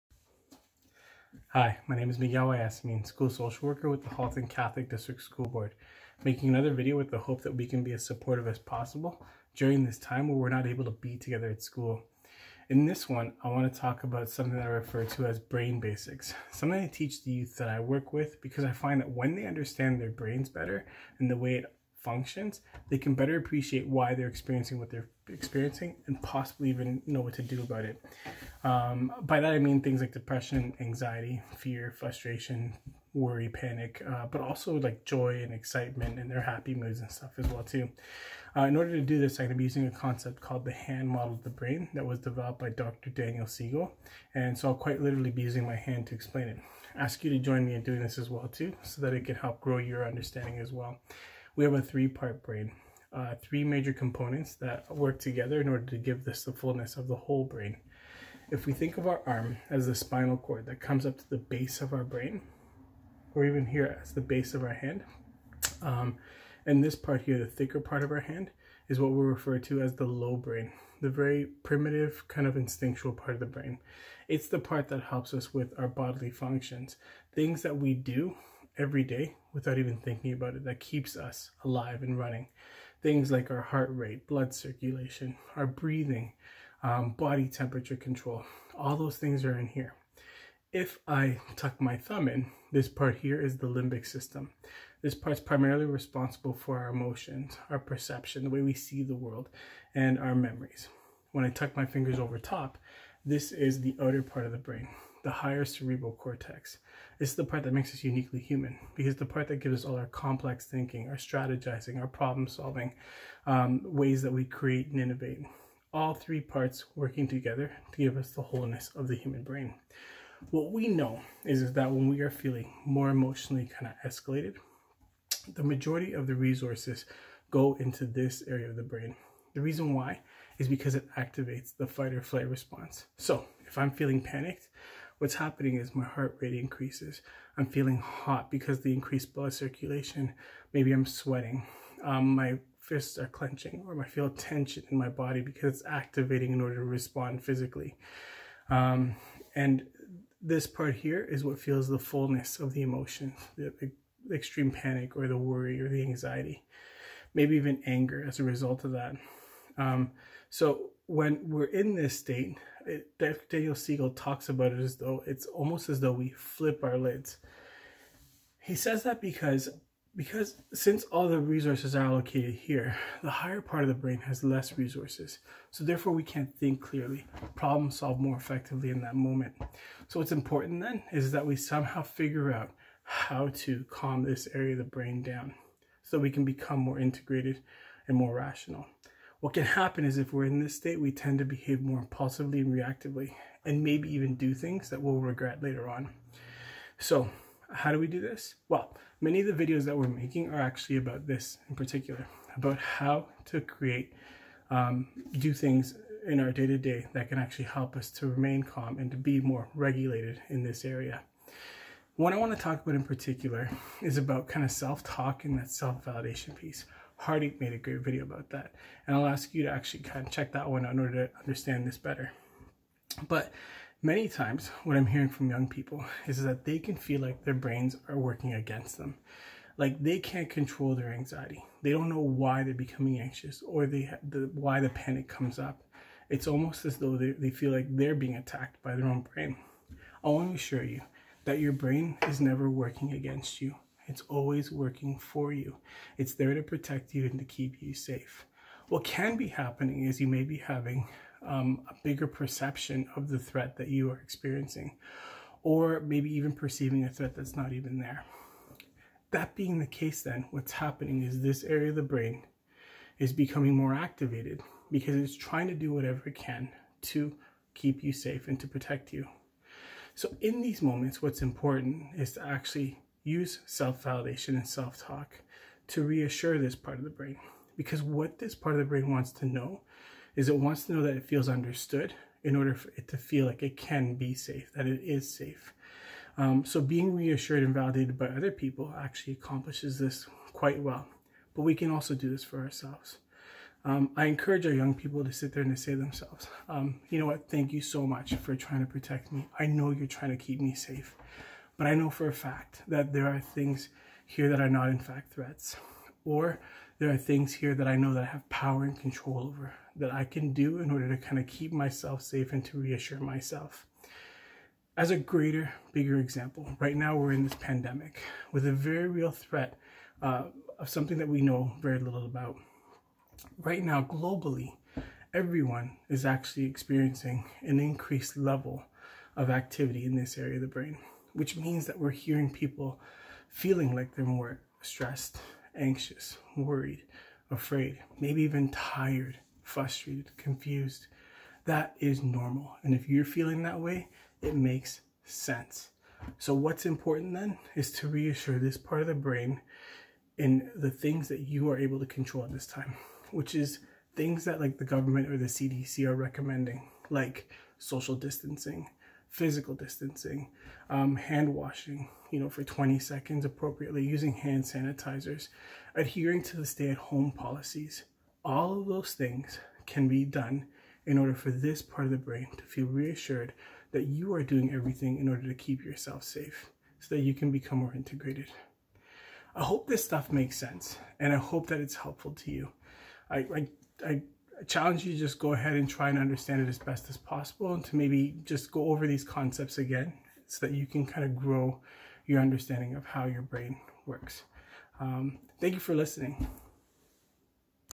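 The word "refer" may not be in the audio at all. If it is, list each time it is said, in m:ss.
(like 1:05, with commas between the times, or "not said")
0:14, 1:09.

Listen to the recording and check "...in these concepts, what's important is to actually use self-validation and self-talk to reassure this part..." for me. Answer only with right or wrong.
wrong.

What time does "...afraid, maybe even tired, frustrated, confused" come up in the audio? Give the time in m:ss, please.
5:37.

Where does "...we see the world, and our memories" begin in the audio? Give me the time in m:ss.
1:38.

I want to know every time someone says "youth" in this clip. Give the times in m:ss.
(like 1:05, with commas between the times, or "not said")
0:17.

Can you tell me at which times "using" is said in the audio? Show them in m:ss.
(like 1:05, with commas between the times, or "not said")
0:39, 0:45, 6:04.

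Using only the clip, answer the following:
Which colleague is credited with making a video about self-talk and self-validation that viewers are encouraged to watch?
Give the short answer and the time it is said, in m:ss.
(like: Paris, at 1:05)
Hardy, at 3:37.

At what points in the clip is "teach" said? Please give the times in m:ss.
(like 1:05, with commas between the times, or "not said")
0:16.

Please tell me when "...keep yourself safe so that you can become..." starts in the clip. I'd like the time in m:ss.
6:15.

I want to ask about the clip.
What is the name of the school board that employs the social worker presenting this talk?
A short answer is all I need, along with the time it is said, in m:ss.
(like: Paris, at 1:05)
Halton Catholic District School Board, at 0:04.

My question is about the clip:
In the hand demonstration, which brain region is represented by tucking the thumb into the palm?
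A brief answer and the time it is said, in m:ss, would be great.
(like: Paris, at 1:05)
The limbic system, at 1:33.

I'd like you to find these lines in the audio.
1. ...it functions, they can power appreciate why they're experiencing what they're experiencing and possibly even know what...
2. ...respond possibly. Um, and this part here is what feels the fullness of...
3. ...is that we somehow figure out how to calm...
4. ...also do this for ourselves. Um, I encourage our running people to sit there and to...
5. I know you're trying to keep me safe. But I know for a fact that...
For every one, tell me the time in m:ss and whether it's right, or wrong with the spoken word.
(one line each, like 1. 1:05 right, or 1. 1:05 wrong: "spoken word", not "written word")
1. 0:21 wrong: "better", not "power"
2. 2:26 wrong: "physically", not "possibly"
3. 3:01 right
4. 4:51 wrong: "young", not "running"
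5. 4:59 right.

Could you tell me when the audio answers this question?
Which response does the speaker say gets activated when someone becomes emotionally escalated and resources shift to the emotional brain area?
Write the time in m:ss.
2:11.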